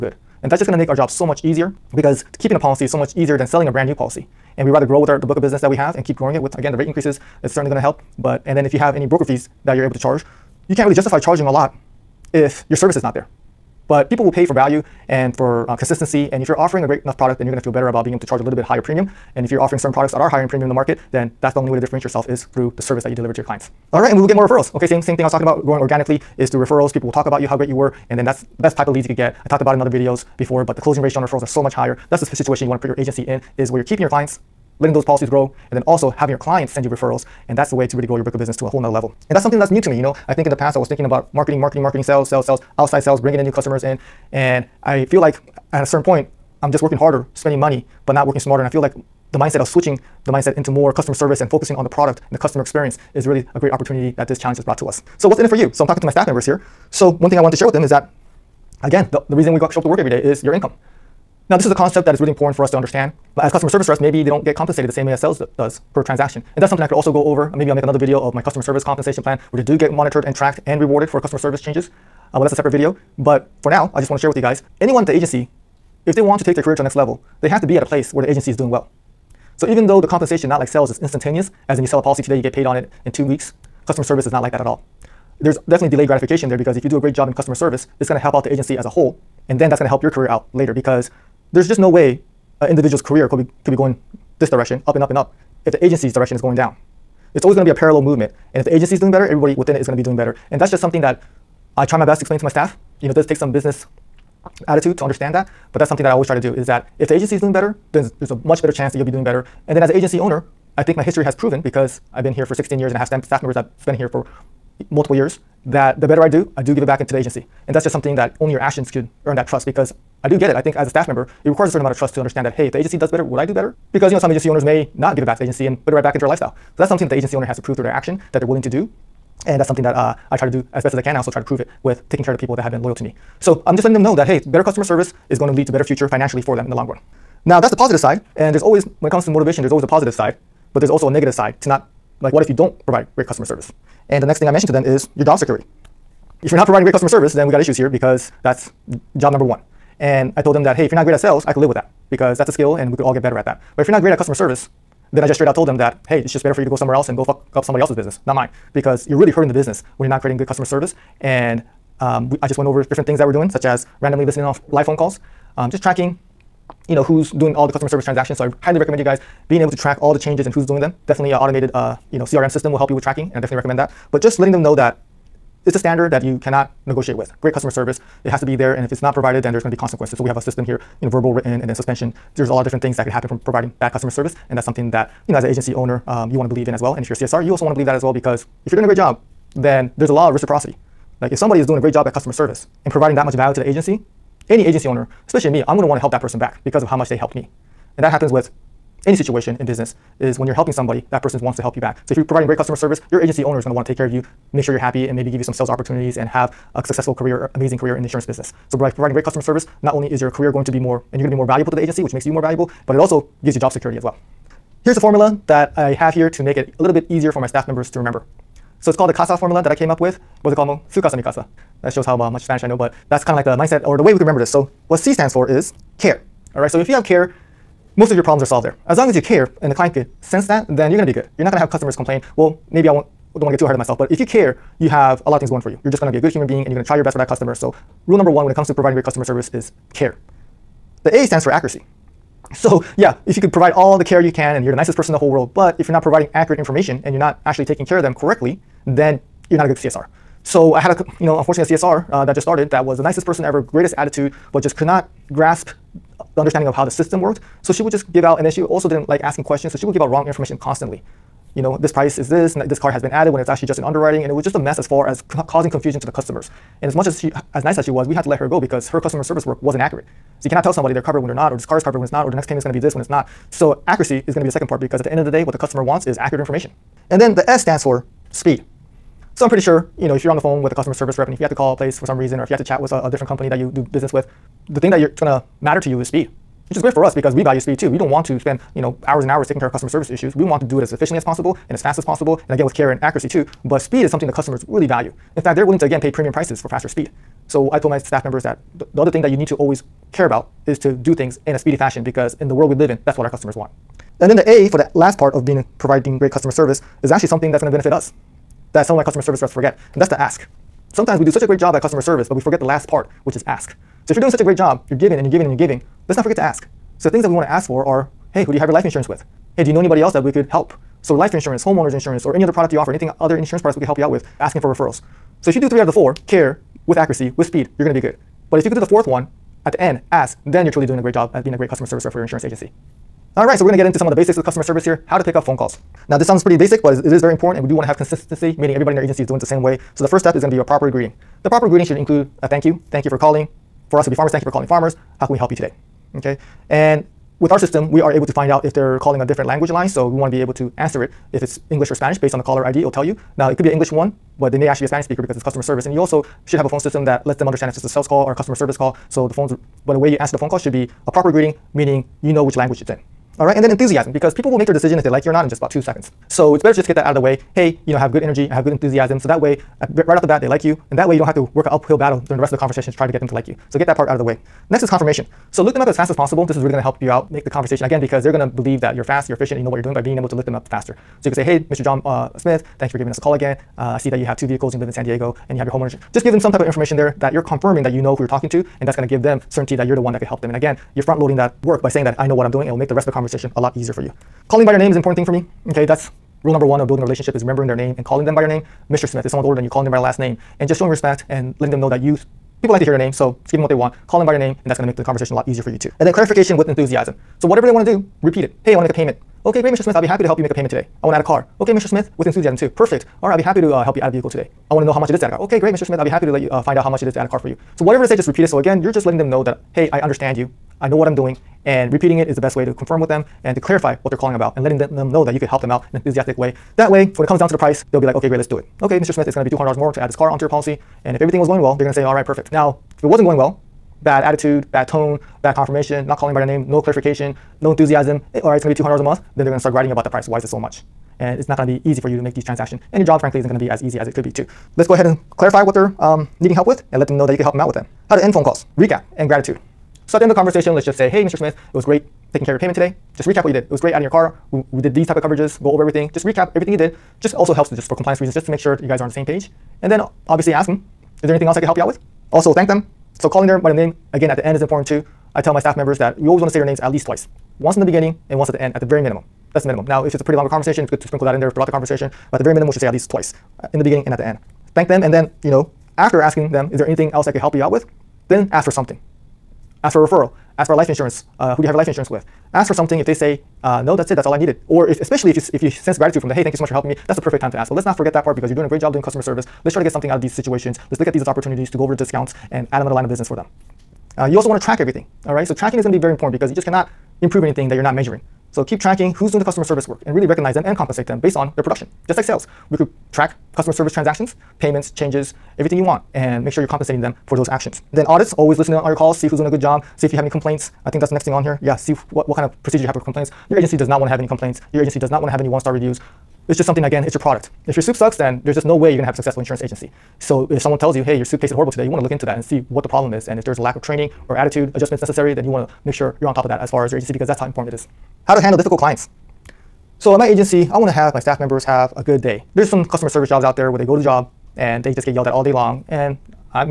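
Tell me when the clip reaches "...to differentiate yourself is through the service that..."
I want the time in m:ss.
0:21.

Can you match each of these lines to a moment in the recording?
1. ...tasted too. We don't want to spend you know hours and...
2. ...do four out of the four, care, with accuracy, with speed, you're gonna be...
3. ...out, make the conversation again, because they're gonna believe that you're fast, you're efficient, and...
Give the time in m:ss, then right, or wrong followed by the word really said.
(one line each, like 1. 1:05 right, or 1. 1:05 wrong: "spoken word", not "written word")
1. 4:47 wrong: "speed", not "tasted"
2. 5:25 wrong: "three", not "four"
3. 6:17 right.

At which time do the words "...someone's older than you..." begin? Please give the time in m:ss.
6:39.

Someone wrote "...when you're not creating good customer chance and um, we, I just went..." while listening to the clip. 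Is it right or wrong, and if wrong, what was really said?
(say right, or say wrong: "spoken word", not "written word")
wrong: "service", not "chance".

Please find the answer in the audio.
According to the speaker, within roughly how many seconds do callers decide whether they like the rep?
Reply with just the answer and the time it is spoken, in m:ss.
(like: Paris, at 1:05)
2 seconds, at 6:05.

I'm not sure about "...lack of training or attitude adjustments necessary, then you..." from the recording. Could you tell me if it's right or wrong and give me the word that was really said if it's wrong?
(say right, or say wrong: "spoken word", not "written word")
right.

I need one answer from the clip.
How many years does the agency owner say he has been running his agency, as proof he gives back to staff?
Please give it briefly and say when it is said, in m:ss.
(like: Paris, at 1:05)
16, at 1:52.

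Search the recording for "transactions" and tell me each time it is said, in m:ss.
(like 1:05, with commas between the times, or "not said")
1:06, 2:48, 7:22, 8:23.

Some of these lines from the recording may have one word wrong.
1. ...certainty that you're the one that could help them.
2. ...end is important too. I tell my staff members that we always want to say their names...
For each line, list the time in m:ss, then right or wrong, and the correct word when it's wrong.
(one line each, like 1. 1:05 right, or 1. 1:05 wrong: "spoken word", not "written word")
1. 6:29 right
2. 7:44 right.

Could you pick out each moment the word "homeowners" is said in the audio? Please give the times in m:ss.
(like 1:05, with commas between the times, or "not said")
5:21, 6:25.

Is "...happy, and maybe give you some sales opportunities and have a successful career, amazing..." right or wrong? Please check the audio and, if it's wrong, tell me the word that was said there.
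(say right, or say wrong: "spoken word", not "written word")
right.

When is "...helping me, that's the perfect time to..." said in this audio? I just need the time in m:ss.
8:06.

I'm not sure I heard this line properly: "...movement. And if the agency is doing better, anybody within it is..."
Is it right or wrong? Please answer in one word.
wrong.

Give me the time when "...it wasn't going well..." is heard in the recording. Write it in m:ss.
7:13.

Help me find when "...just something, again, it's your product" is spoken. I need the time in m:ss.
8:36.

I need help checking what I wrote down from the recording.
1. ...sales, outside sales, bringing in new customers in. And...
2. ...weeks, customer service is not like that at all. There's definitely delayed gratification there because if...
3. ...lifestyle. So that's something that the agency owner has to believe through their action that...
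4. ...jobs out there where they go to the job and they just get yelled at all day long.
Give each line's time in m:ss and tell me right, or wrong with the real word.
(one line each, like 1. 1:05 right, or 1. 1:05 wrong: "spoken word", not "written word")
1. 0:42 right
2. 1:23 right
3. 2:06 wrong: "prove", not "believe"
4. 8:53 right.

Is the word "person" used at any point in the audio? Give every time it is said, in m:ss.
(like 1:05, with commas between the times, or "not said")
3:16, 3:21, 4:04, 4:13.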